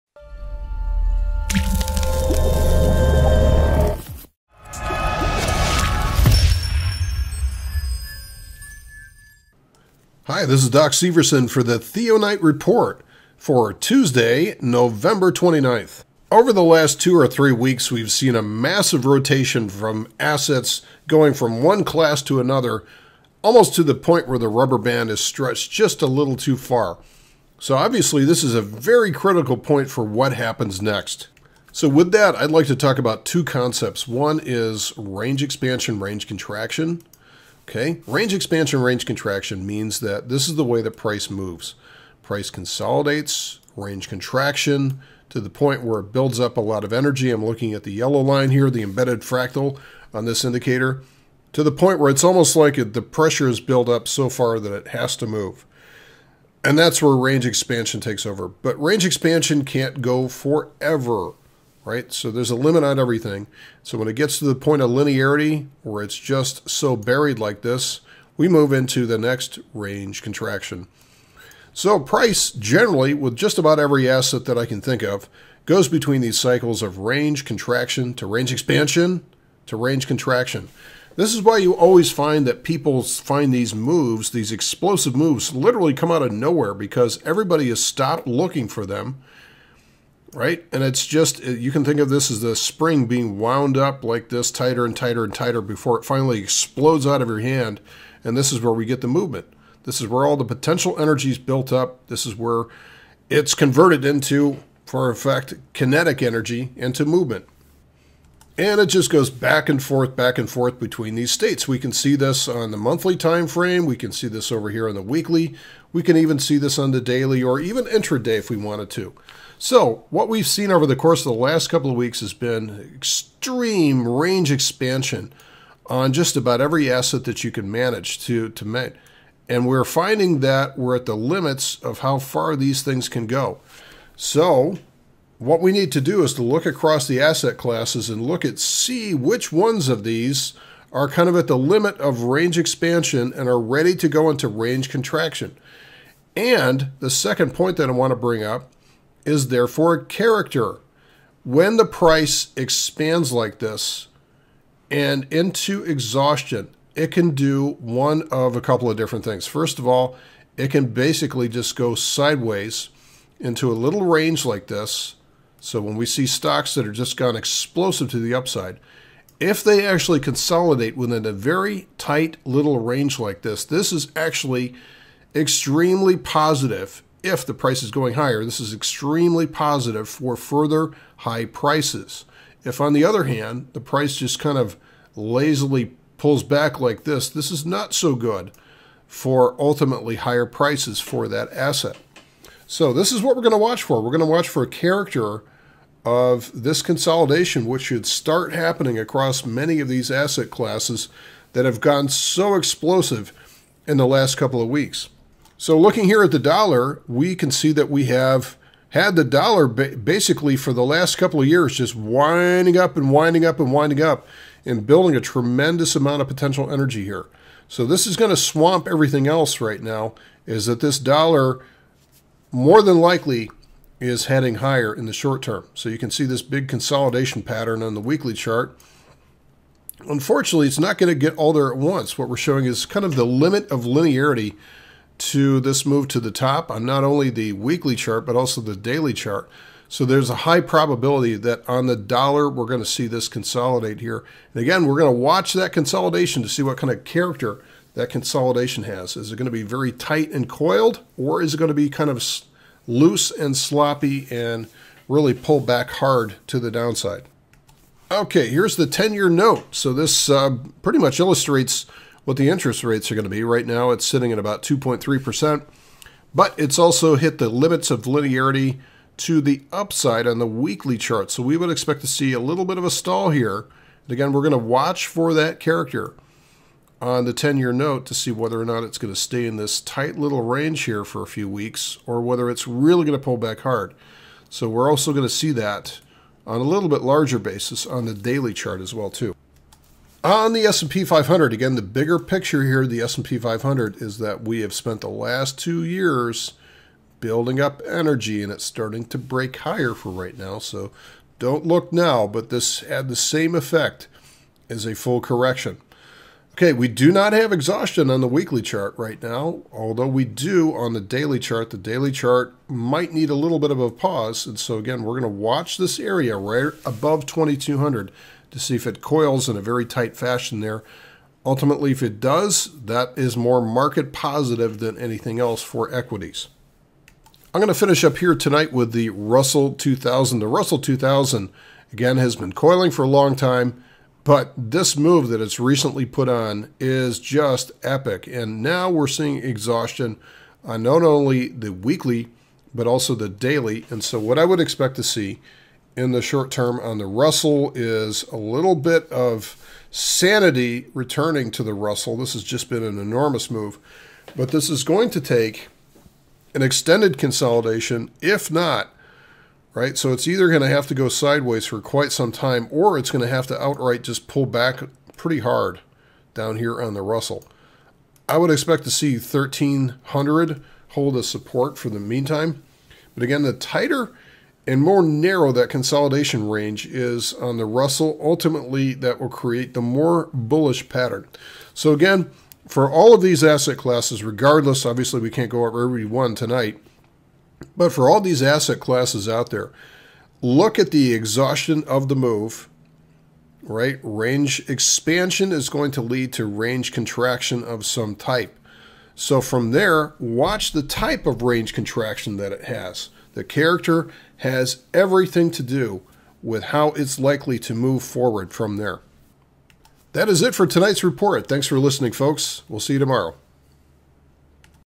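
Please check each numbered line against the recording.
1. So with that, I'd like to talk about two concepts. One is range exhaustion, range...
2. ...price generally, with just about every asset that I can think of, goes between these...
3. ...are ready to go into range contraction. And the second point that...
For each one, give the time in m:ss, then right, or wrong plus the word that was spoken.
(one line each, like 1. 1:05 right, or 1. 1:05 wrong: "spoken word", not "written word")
1. 0:31 wrong: "expansion", not "exhaustion"
2. 1:11 right
3. 2:23 right.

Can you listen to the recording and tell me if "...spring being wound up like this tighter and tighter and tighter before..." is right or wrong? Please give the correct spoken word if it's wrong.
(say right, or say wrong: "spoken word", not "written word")
right.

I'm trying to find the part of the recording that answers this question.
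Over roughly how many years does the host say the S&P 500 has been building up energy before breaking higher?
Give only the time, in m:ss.
4:55.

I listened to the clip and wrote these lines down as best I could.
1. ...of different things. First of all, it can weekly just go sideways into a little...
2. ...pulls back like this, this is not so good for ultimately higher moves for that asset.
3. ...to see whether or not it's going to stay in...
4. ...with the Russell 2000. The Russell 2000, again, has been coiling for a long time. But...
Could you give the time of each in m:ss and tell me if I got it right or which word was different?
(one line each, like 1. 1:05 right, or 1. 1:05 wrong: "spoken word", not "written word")
1. 2:38 wrong: "basically", not "weekly"
2. 3:06 wrong: "prices", not "moves"
3. 4:38 right
4. 5:28 right.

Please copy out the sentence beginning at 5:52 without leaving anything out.
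This has just been an enormous move, but this is going to take an extended consolidation, if not right?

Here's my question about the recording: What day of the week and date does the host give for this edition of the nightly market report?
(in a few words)
Tuesday, November 29th.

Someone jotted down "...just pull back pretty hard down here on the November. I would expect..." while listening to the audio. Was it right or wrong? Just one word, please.
wrong.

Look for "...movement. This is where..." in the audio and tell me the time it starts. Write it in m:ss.
1:39.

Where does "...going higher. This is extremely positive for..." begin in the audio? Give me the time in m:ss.
2:57.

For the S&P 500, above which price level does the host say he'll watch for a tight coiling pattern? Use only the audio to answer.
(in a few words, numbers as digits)
2200.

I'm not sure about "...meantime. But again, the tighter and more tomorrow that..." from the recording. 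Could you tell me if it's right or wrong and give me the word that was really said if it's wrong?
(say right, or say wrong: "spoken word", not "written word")
wrong: "narrow", not "tomorrow".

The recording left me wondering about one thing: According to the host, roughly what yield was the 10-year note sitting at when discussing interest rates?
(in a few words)
2.3%.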